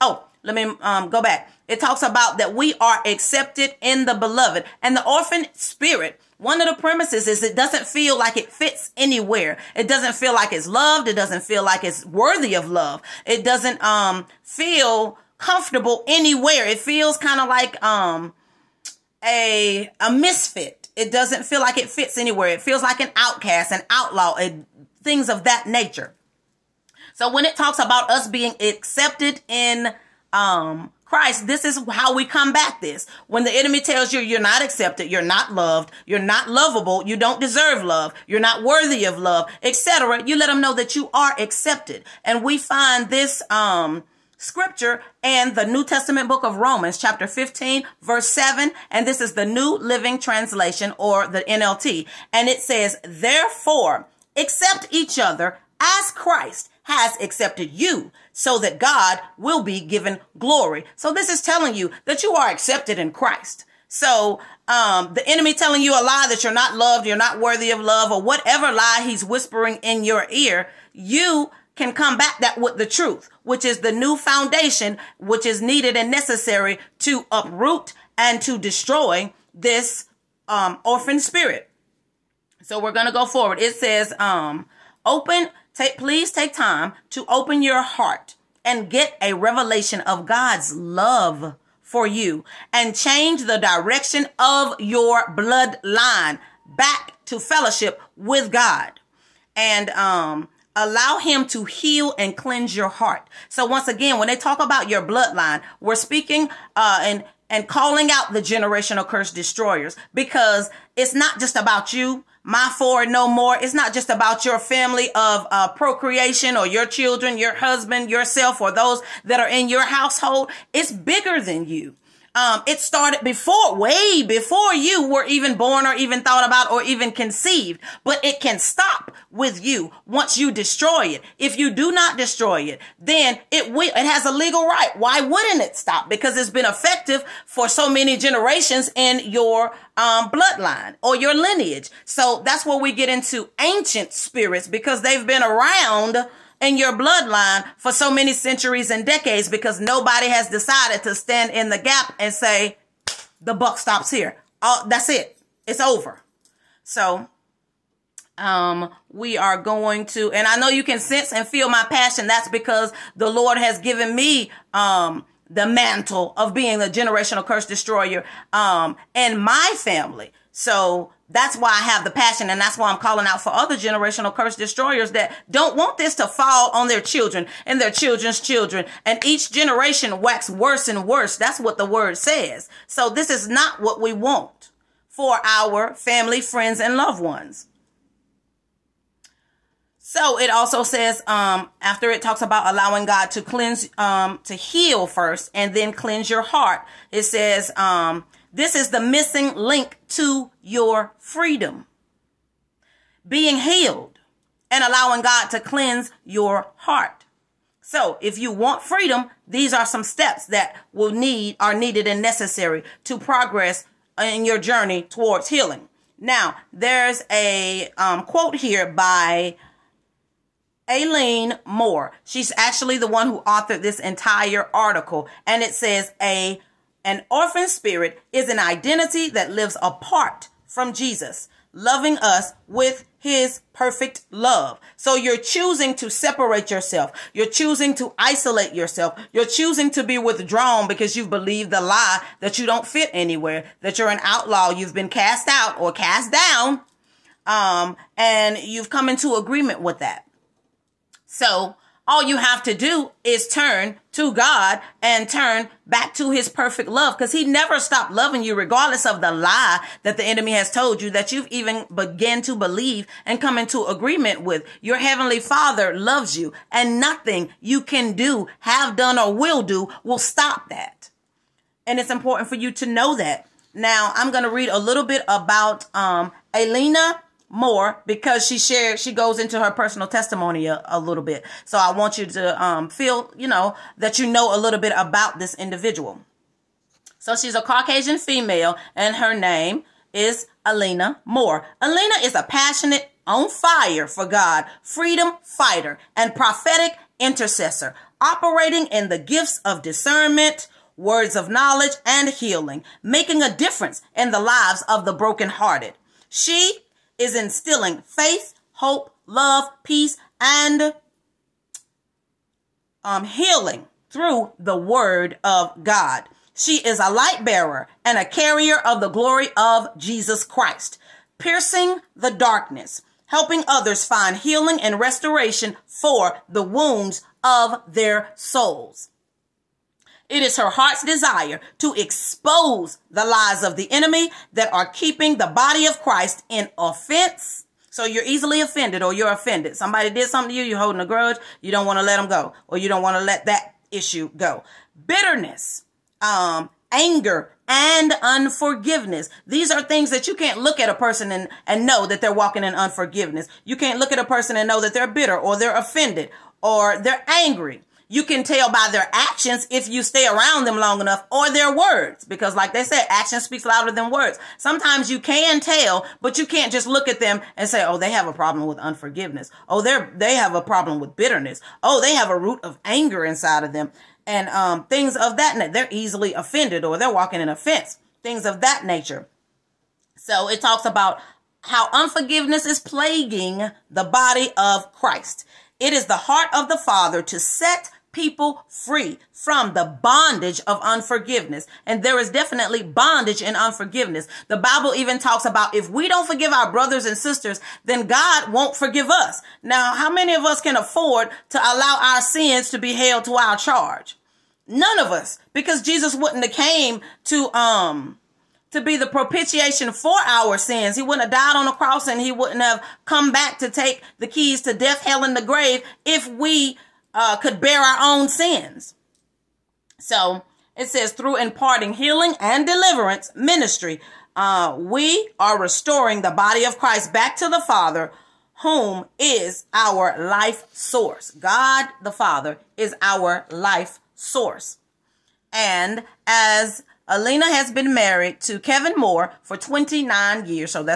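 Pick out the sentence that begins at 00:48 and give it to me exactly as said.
And this is the New Living Translation or the NLT.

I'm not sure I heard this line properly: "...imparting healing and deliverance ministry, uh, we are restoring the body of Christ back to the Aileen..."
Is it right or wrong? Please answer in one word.
wrong.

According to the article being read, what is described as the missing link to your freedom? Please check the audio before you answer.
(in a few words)
allowing God to cleanse your heart.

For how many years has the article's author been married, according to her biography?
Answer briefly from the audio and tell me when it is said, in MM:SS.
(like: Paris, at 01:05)
29, at 07:19.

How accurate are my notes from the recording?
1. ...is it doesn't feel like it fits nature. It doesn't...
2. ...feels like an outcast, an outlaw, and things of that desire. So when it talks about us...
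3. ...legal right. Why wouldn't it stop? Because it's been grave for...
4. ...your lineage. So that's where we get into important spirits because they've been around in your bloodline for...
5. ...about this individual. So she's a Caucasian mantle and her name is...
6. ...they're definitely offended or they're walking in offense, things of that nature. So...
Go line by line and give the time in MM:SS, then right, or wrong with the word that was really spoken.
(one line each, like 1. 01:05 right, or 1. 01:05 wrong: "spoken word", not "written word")
1. 00:07 wrong: "anywhere", not "nature"
2. 00:22 wrong: "nature", not "desire"
3. 02:14 wrong: "effective", not "grave"
4. 02:21 wrong: "ancient", not "important"
5. 04:44 wrong: "female", not "mantle"
6. 06:15 wrong: "easily", not "definitely".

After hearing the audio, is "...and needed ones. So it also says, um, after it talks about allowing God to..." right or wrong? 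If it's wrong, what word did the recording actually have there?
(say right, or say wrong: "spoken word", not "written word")
wrong: "loved", not "needed".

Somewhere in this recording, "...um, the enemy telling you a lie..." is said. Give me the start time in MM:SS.
01:04.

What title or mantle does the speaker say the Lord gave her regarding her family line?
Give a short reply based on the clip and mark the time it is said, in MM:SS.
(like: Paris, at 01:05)
generational curse destroyer, at 02:46.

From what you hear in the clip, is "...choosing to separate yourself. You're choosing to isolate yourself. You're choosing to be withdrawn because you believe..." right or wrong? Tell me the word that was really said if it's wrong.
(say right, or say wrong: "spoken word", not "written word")
right.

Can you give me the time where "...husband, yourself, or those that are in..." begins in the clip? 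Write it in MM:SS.
01:57.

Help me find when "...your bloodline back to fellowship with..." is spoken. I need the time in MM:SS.
01:34.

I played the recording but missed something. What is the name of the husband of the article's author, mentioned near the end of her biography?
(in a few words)
Kevin Moore.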